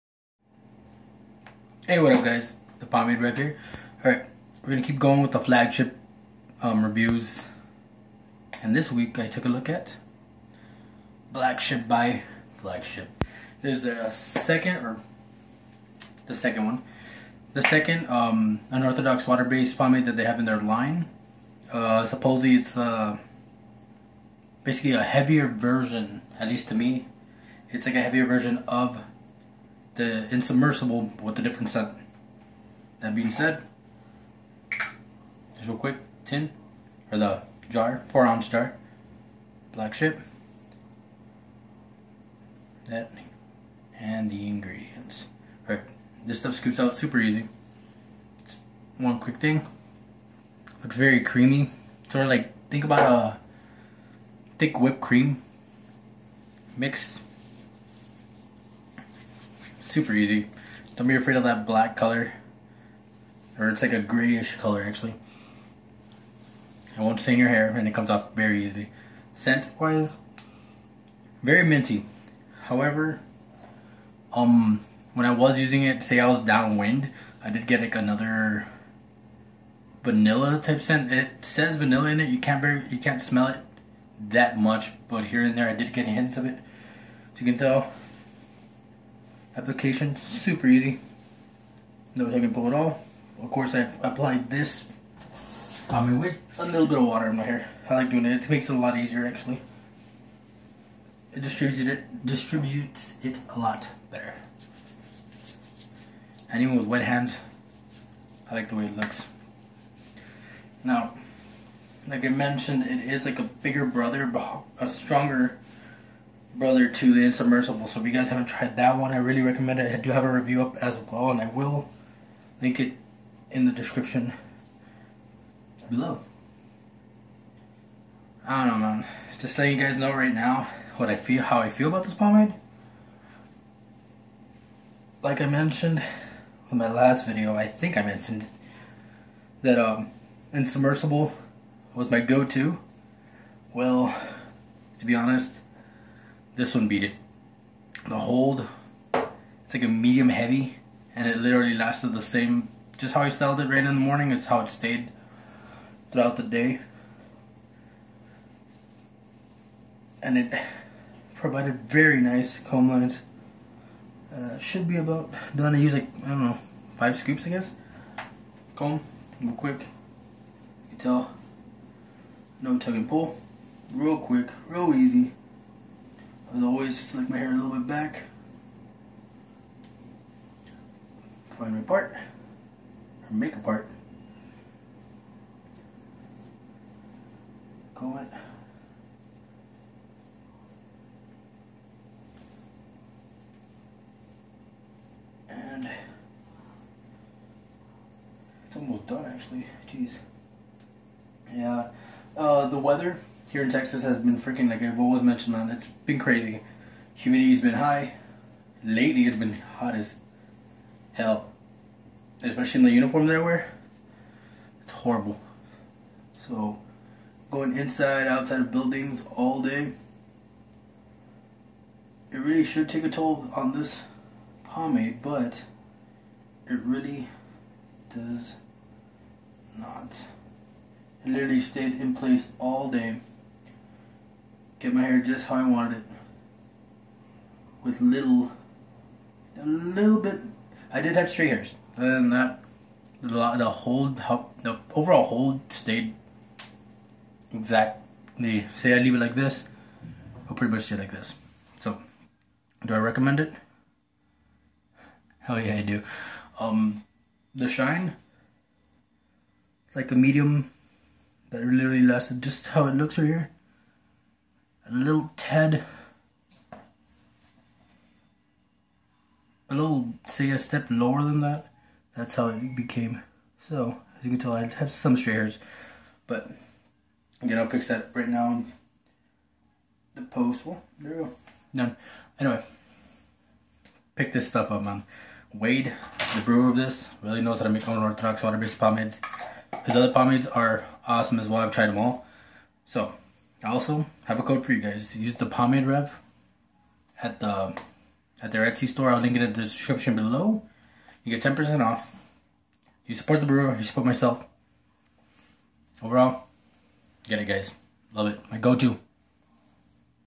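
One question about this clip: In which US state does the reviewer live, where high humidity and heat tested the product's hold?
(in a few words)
Texas.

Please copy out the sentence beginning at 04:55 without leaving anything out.
Use the pomade rev at the at their Etsy store.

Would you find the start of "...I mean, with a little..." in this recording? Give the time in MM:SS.
01:35.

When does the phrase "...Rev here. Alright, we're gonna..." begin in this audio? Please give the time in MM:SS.
00:03.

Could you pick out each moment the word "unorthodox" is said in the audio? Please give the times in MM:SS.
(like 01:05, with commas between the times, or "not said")
00:18, 04:47.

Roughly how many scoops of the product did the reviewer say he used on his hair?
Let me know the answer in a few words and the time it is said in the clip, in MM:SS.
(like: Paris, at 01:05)
5, at 02:46.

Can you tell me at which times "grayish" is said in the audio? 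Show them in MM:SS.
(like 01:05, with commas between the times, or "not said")
01:03.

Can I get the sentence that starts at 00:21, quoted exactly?
Uh, supposedly it's uh, basically a heavier version, at least to me.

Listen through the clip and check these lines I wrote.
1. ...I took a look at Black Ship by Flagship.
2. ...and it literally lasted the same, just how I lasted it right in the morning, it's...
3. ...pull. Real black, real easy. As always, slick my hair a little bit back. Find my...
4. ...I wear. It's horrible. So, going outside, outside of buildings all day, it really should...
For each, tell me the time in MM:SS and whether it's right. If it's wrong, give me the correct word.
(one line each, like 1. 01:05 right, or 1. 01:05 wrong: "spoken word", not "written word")
1. 00:09 right
2. 02:31 wrong: "styled", not "lasted"
3. 02:53 wrong: "quick", not "black"
4. 03:33 wrong: "inside", not "outside".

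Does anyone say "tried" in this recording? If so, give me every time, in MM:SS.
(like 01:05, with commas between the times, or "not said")
01:58, 04:51.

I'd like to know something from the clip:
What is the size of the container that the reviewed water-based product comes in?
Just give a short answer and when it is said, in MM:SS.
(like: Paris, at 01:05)
4 ounces, at 00:38.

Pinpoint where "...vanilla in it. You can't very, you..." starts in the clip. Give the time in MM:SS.
01:21.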